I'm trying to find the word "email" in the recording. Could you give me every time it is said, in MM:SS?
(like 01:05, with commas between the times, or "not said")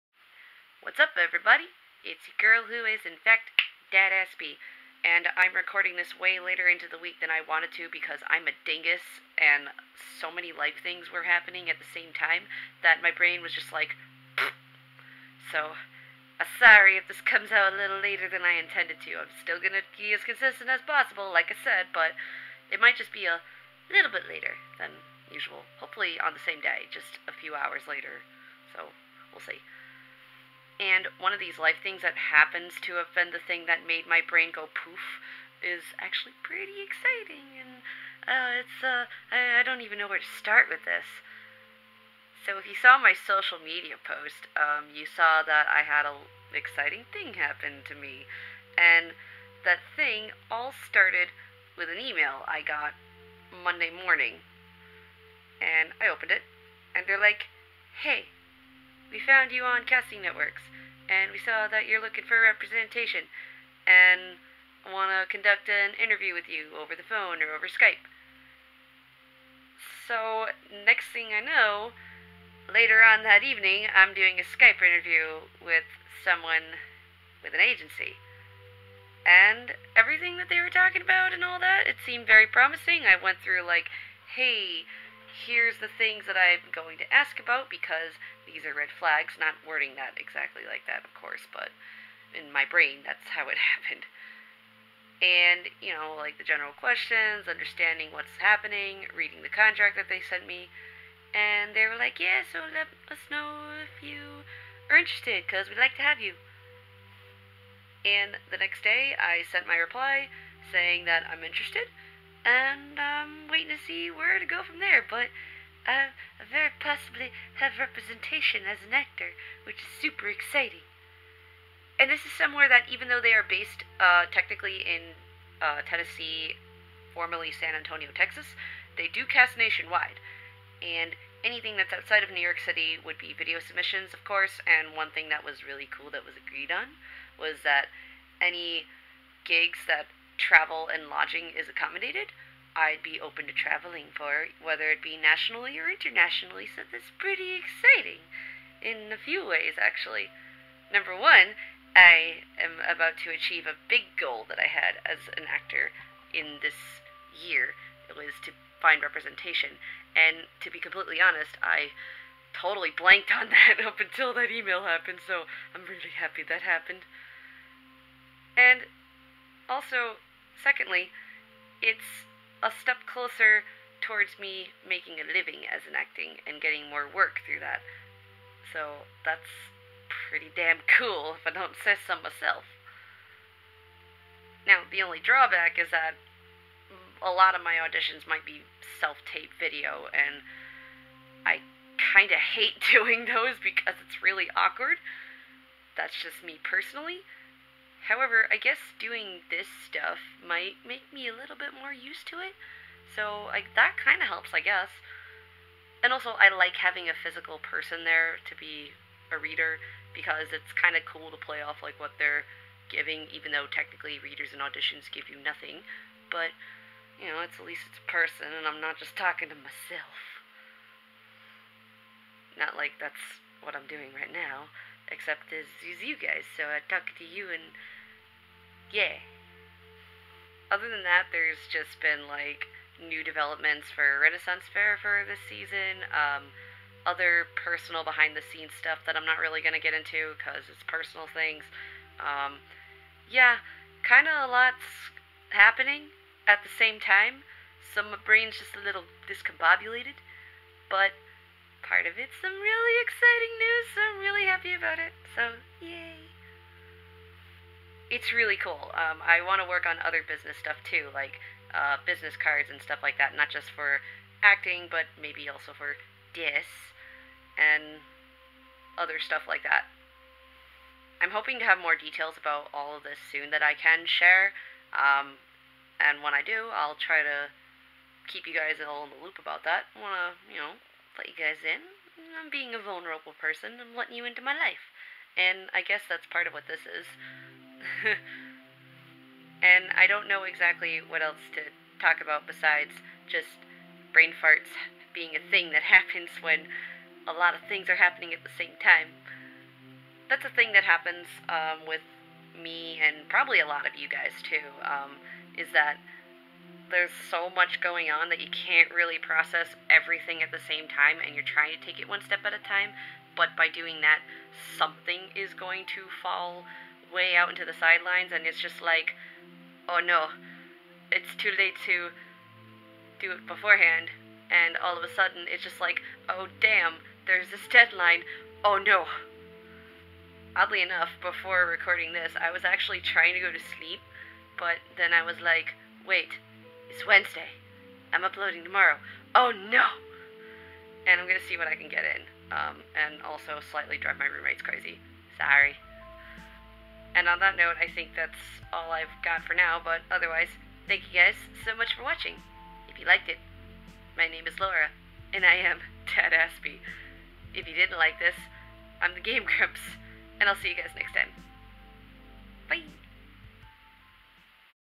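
00:52, 02:44.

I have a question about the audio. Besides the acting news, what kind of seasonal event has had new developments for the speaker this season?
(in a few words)
Renaissance Fair.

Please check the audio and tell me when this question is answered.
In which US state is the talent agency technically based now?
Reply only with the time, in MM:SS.
02:05.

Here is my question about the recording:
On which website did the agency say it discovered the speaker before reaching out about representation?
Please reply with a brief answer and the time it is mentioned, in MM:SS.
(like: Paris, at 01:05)
Casting Networks, at 00:59.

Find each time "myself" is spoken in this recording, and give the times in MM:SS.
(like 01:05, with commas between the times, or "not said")
03:02, 03:39.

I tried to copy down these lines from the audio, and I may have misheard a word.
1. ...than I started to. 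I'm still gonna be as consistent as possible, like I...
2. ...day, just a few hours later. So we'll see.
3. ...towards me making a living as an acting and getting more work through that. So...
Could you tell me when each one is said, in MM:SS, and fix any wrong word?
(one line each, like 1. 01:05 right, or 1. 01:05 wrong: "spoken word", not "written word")
1. 00:18 wrong: "intended", not "started"
2. 00:26 right
3. 02:53 right.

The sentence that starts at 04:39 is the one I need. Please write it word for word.
I wanna, you know, let you guys in.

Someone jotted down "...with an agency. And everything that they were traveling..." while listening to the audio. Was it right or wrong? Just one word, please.
wrong.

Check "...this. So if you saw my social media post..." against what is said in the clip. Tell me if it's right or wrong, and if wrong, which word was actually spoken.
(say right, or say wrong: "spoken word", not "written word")
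right.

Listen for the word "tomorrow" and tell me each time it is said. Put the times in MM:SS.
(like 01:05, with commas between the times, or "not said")
05:38.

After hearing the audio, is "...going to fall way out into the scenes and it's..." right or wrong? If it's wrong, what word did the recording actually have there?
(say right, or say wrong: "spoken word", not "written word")
wrong: "sidelines", not "scenes".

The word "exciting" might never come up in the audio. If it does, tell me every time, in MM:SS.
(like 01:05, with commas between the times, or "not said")
00:36, 00:46, 02:00, 02:27, 04:13.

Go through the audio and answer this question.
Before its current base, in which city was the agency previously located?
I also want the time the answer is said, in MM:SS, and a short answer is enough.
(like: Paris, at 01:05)
San Antonio, Texas, at 02:07.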